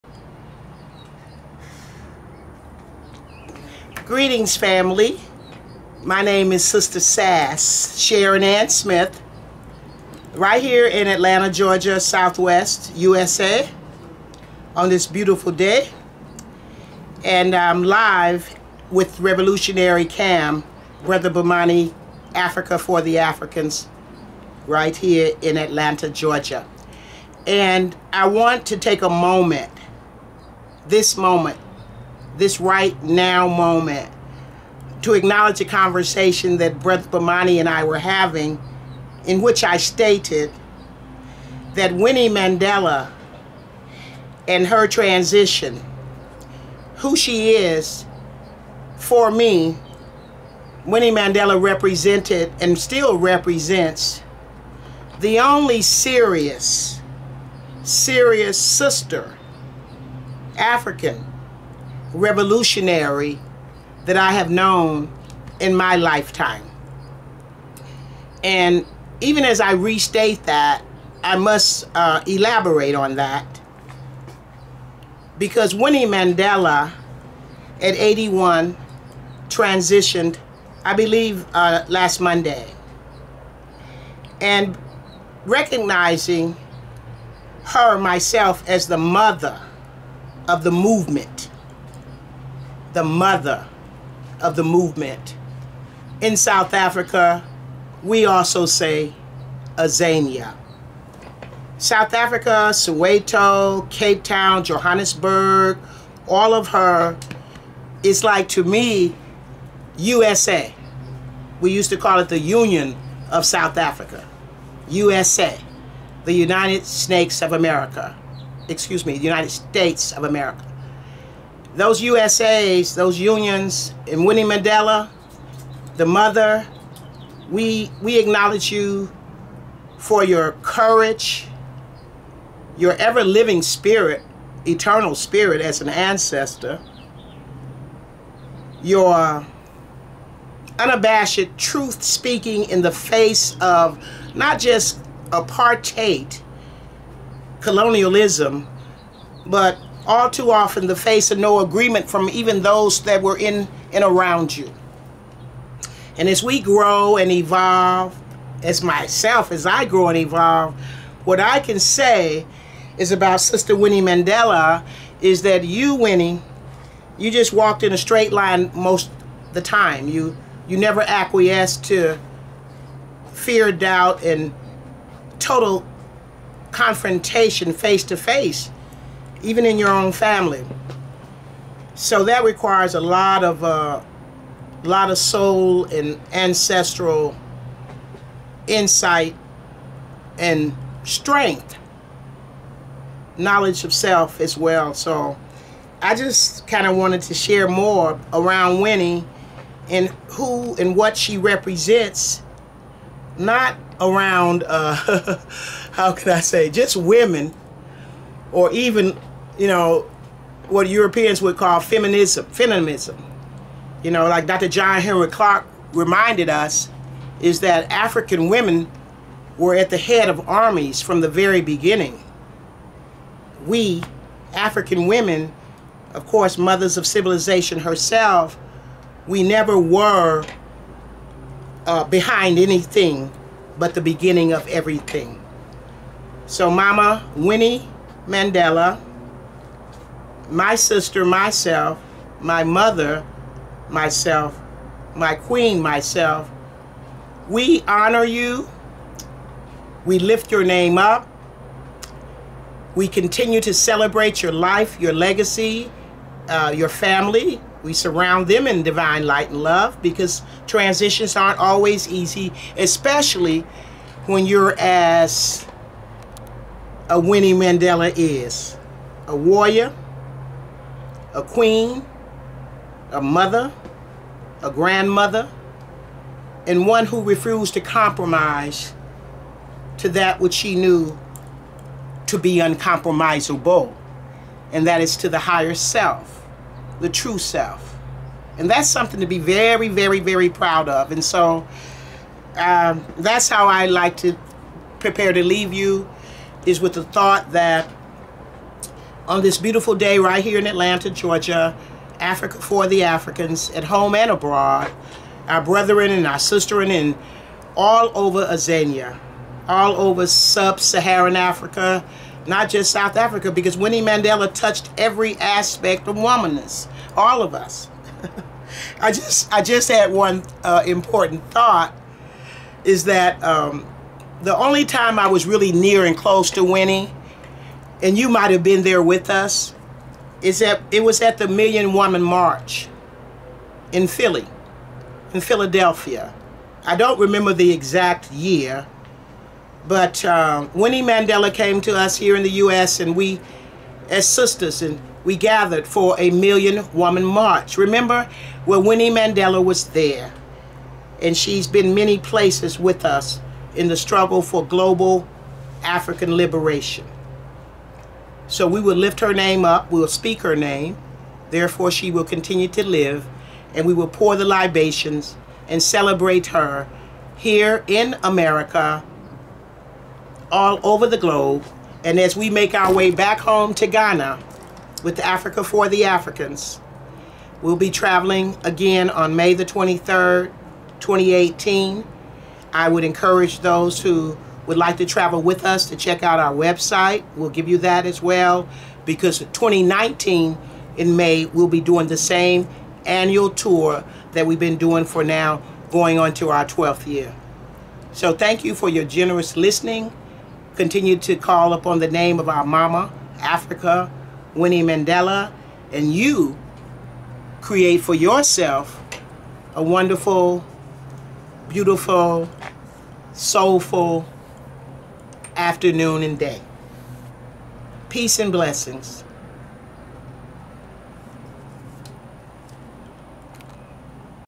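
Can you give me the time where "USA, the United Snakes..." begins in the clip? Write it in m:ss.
1:54.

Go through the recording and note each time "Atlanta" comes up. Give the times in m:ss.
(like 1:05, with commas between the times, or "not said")
0:11, 0:25, 5:00.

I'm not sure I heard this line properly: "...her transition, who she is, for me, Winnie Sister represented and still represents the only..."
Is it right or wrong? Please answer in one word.
wrong.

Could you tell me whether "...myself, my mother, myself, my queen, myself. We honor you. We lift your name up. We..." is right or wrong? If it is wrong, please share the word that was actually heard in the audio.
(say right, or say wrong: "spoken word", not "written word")
right.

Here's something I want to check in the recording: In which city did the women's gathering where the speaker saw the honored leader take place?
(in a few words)
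Philadelphia.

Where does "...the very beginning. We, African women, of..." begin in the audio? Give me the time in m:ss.
3:41.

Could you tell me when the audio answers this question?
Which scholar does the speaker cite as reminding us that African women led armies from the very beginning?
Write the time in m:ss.
3:34.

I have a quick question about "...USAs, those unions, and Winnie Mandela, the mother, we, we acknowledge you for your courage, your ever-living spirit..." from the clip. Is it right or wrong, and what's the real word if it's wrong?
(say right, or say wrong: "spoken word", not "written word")
right.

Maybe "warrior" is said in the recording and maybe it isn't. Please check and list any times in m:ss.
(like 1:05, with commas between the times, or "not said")
4:29.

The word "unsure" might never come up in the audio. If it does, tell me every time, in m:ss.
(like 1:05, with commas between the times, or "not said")
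not said.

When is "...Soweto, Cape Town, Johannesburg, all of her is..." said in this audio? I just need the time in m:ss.
1:42.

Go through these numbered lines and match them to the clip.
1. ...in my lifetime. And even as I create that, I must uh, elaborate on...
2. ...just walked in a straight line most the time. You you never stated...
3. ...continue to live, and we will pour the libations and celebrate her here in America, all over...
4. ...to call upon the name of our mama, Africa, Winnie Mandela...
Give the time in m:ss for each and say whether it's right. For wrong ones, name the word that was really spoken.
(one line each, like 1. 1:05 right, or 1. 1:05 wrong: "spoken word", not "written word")
1. 1:05 wrong: "restate", not "create"
2. 2:47 wrong: "acquiesced", not "stated"
3. 6:02 right
4. 6:41 right.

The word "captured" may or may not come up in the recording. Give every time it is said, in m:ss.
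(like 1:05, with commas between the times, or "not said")
not said.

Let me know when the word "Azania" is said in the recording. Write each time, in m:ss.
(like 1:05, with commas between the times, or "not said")
1:39, 5:08.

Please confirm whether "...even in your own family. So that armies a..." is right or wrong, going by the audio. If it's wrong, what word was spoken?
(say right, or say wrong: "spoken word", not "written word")
wrong: "requires", not "armies".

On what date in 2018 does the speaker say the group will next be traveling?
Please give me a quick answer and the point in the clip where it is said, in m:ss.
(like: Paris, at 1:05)
May 23, 2018, at 6:19.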